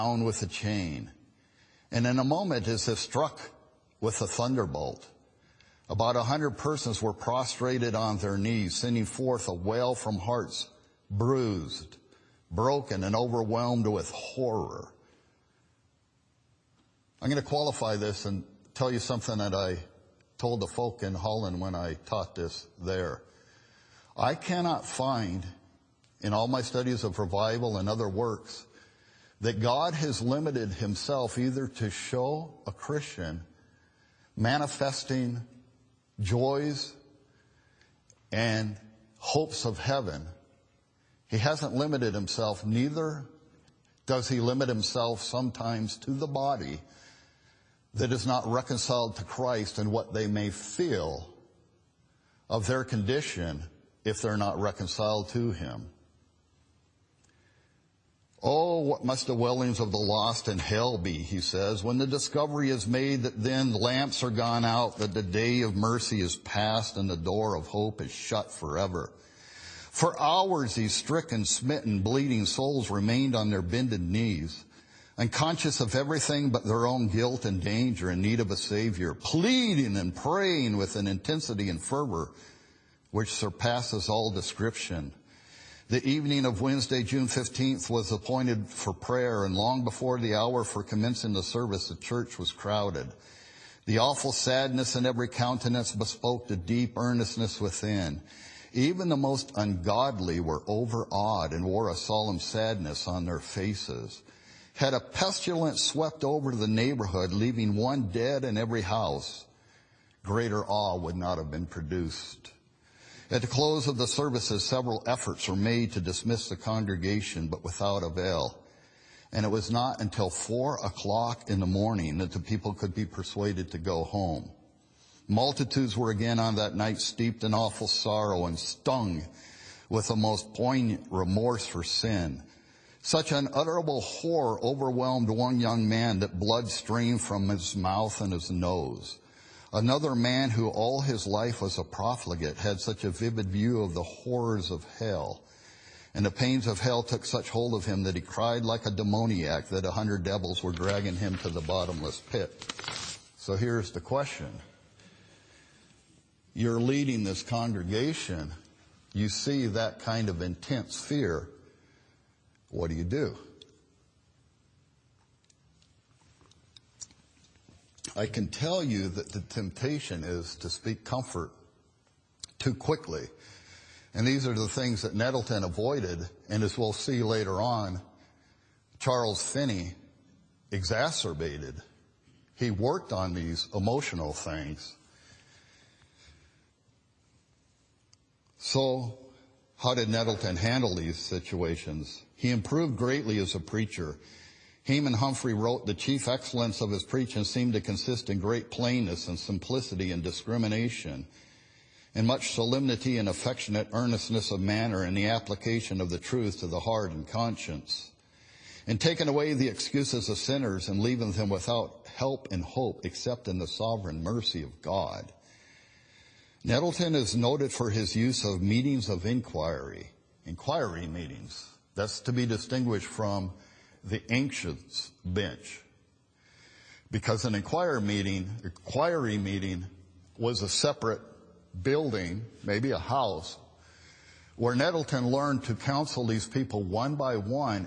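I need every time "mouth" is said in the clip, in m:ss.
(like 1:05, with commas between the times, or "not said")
2:17.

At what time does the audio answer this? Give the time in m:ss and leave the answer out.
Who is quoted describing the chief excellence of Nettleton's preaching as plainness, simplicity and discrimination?
3:14.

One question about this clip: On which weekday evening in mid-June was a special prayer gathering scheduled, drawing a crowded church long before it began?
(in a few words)
Wednesday.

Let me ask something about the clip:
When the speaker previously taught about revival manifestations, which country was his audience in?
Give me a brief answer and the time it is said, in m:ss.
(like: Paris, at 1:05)
Holland, at 0:21.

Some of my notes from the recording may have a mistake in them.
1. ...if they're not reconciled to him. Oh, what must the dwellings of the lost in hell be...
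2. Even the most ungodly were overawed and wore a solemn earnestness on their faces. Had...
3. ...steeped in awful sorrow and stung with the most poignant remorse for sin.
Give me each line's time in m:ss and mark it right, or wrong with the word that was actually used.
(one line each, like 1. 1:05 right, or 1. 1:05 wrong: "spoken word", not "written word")
1. 0:54 right
2. 1:38 wrong: "sadness", not "earnestness"
3. 2:07 right.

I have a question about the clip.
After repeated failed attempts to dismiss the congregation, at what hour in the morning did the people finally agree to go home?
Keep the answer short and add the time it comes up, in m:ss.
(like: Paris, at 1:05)
4 o'clock, at 2:00.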